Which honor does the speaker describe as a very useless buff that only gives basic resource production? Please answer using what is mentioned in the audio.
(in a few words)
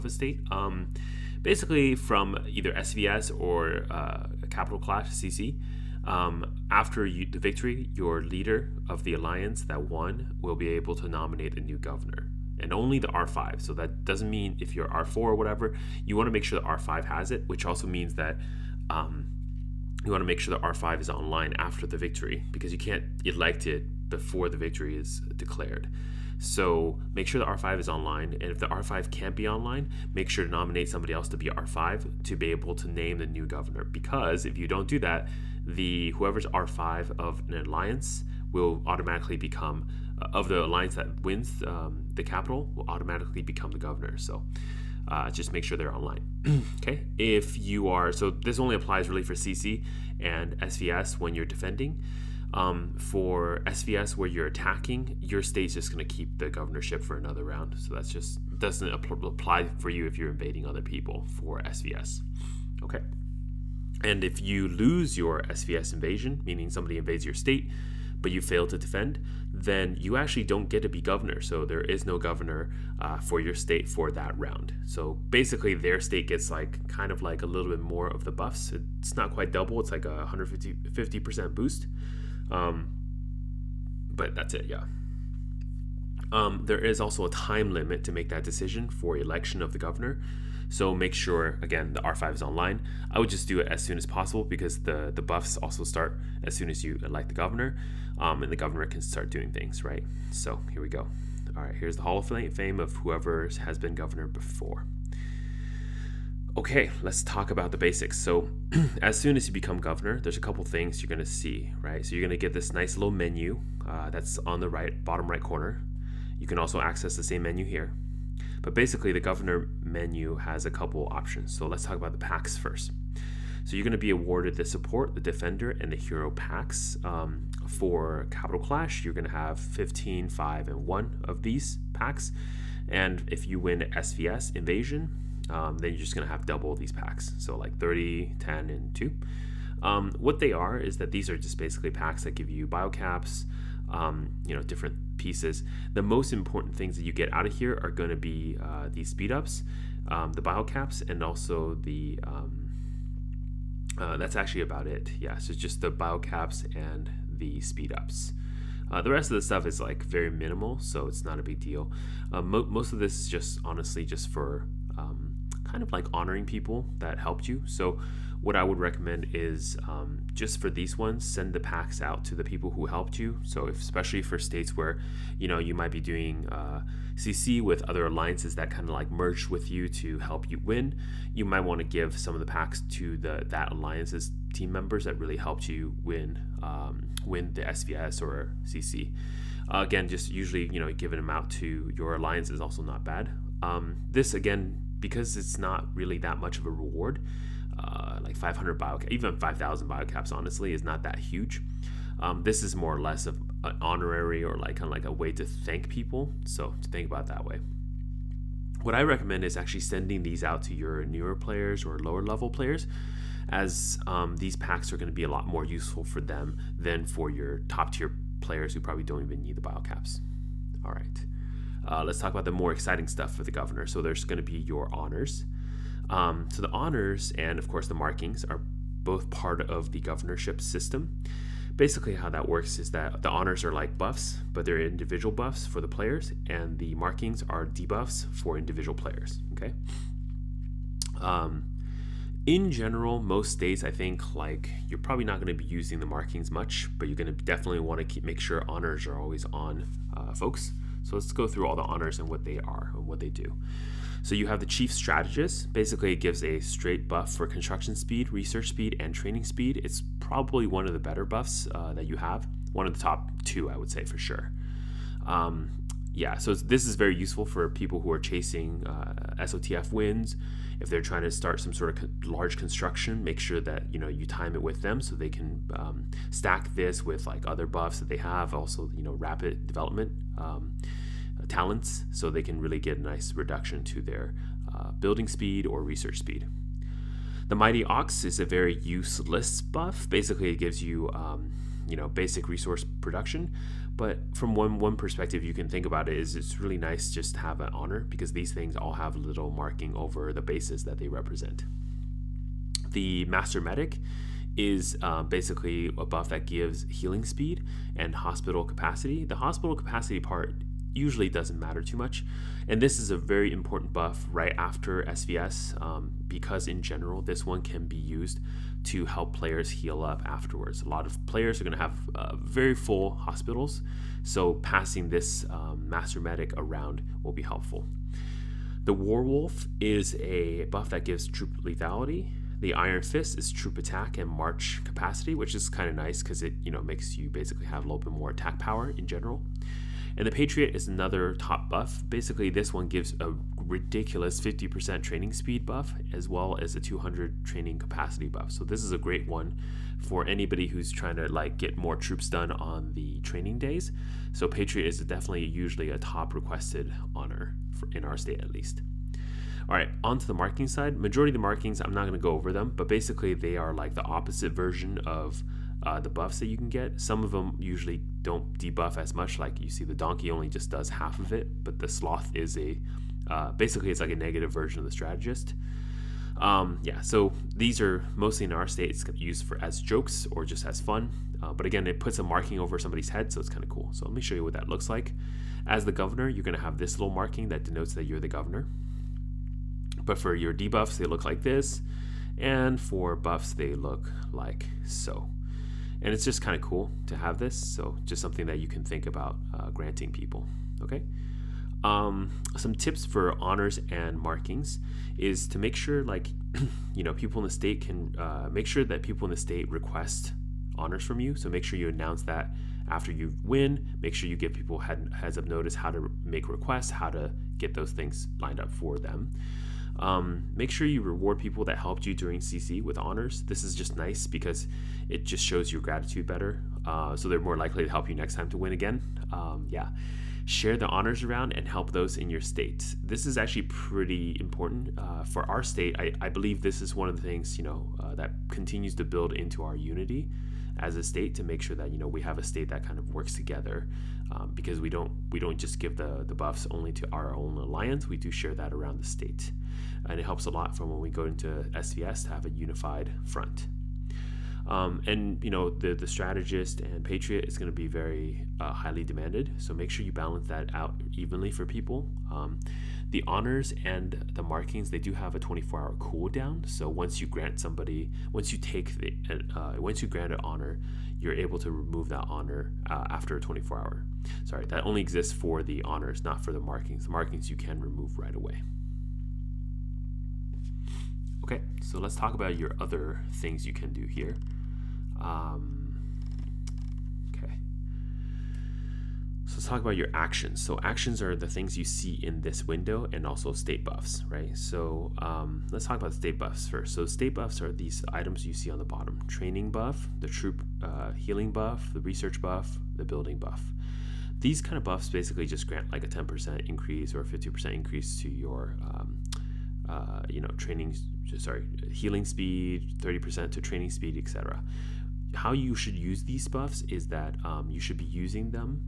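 The Mighty Ox.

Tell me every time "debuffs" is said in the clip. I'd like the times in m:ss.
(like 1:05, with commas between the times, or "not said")
3:57, 6:08, 6:30.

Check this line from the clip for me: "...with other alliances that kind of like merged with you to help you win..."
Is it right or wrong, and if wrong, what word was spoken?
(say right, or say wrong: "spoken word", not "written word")
right.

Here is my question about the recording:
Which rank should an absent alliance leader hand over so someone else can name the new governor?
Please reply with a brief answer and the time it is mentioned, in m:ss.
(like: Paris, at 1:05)
R5, at 0:30.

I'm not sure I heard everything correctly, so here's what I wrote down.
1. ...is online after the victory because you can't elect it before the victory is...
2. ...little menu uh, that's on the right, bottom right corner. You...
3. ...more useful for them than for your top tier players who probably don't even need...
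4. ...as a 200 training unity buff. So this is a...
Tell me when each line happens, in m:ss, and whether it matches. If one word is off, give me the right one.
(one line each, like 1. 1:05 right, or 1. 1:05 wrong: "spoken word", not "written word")
1. 0:21 right
2. 1:52 right
3. 3:35 right
4. 5:46 wrong: "capacity", not "unity".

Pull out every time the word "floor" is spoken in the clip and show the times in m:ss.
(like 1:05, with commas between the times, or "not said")
not said.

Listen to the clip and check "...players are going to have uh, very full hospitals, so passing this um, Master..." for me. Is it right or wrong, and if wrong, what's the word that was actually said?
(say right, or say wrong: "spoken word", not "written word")
right.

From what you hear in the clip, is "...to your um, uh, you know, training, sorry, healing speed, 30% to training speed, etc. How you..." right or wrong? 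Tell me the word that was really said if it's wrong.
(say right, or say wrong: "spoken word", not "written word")
right.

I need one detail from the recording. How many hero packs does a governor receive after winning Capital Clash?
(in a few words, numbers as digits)
1.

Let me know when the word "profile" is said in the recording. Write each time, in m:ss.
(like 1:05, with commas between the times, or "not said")
not said.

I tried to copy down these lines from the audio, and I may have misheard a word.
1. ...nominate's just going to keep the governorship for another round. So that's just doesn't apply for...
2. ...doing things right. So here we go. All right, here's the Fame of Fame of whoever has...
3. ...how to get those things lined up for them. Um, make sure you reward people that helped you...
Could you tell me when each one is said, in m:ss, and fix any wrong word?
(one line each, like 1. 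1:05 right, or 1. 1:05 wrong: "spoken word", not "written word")
1. 0:55 wrong: "state", not "nominate"
2. 1:39 wrong: "Hall", not "Fame"
3. 6:56 right.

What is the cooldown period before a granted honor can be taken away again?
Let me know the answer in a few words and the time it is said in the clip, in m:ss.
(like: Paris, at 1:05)
24 hours, at 7:45.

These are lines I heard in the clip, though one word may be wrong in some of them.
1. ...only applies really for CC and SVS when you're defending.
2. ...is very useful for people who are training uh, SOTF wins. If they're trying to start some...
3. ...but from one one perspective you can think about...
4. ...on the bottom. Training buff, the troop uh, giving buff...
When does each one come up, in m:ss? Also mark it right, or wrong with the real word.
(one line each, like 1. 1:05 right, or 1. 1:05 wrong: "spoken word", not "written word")
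1. 0:48 right
2. 4:26 wrong: "chasing", not "training"
3. 4:53 right
4. 8:18 wrong: "healing", not "giving".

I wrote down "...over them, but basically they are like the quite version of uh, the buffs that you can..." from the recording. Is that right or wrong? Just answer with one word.
wrong.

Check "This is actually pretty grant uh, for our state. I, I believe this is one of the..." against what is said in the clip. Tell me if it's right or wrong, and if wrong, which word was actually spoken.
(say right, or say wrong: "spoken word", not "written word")
wrong: "important", not "grant".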